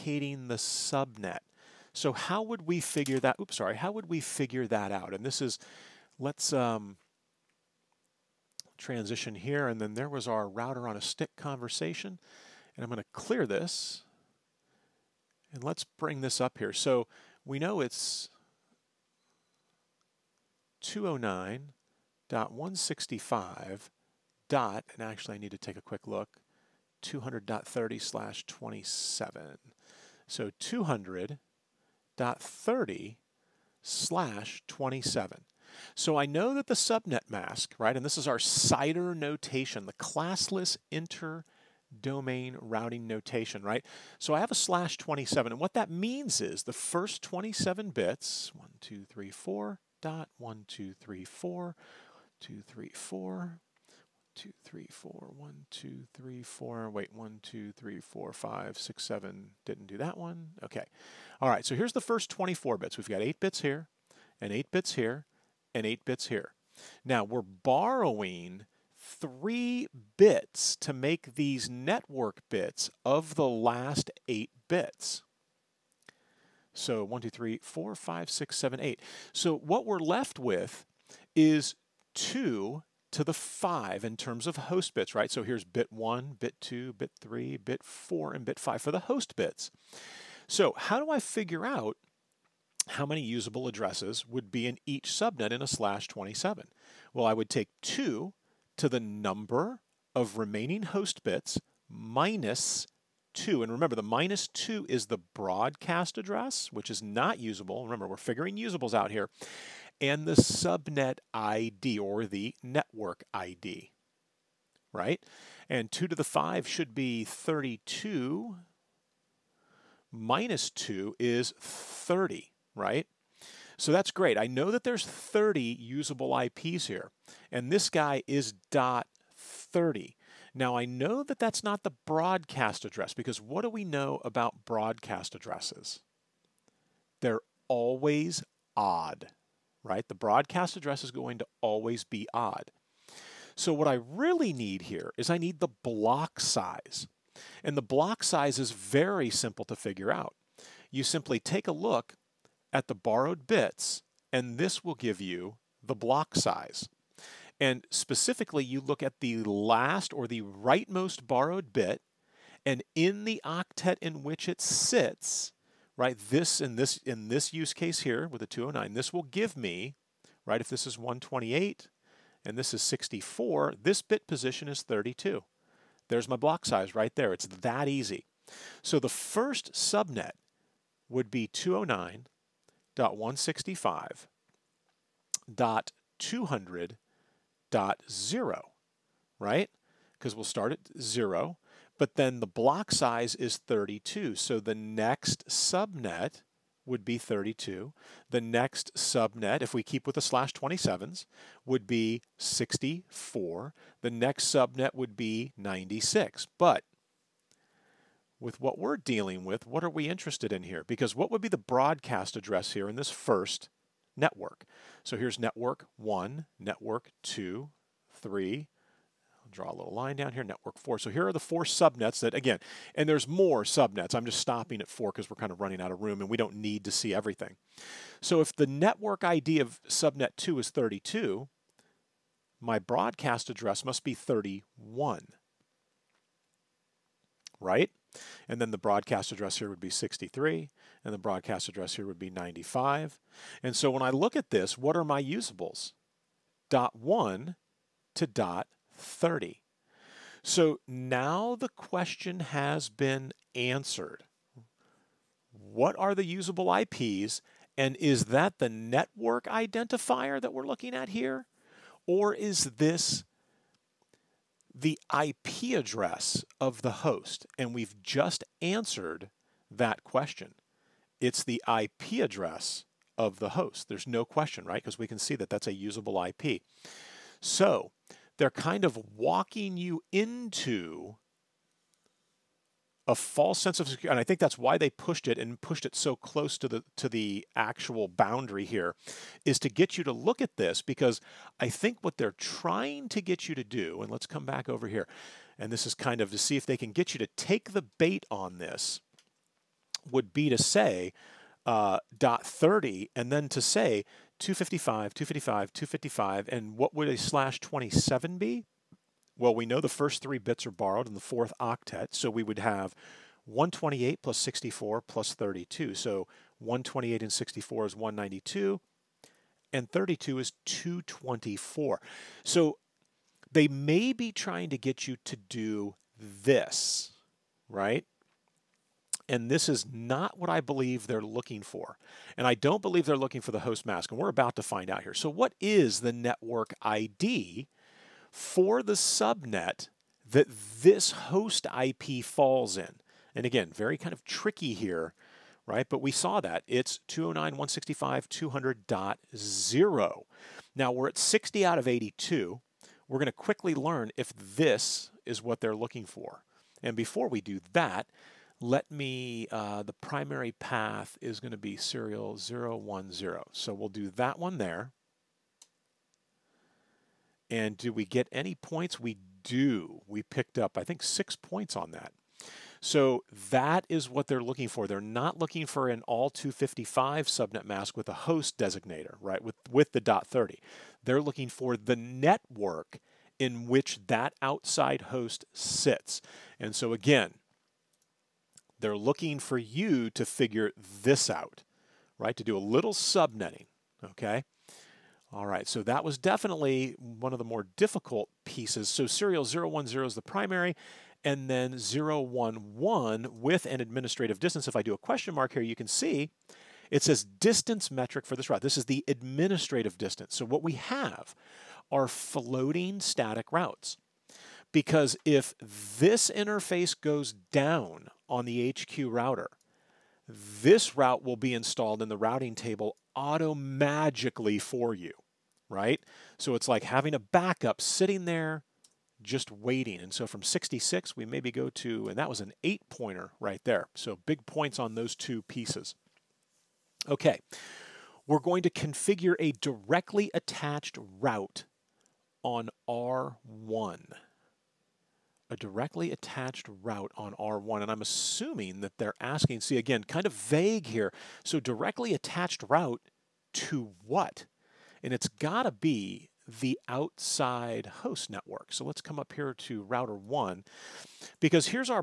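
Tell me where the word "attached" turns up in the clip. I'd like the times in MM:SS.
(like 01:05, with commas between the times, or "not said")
07:20, 07:26, 07:32.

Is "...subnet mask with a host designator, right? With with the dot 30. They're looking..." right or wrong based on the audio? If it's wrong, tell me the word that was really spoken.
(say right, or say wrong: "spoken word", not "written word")
right.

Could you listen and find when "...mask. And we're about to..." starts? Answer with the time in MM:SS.
05:33.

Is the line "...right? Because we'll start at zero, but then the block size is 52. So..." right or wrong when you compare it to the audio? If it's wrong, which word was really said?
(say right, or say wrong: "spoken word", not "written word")
wrong: "32", not "52".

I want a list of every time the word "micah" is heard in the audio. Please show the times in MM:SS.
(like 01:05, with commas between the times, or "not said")
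not said.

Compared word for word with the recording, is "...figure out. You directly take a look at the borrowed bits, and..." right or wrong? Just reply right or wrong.
wrong.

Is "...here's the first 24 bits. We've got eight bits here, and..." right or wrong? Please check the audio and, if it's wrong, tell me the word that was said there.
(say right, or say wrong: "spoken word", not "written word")
right.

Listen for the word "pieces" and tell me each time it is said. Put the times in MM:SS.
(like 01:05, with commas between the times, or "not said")
06:38, 07:15.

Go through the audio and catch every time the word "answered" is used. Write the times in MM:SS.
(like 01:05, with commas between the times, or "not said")
04:13, 04:28.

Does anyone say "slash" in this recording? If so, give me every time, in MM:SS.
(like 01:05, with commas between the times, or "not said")
00:28, 00:33, 00:44, 01:35, 03:20, 05:07.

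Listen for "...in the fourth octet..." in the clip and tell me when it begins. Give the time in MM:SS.
05:11.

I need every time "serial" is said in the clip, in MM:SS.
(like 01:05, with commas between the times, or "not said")
06:01, 06:39.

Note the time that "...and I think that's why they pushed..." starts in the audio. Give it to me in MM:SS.
04:44.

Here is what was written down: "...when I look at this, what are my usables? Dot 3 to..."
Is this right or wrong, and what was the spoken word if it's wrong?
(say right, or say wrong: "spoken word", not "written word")
wrong: "1", not "3".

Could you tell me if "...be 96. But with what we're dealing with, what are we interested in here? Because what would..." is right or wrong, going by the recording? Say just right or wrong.
right.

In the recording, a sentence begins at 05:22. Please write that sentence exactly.
So they may be trying to get you to do this, right?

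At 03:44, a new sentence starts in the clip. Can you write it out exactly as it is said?
I'm just stopping at four because we're kind of running out of room and we don't need to see everything.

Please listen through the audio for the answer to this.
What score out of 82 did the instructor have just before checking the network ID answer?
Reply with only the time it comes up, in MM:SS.
05:51.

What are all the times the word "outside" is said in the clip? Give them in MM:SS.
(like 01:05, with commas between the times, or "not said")
06:24, 07:36.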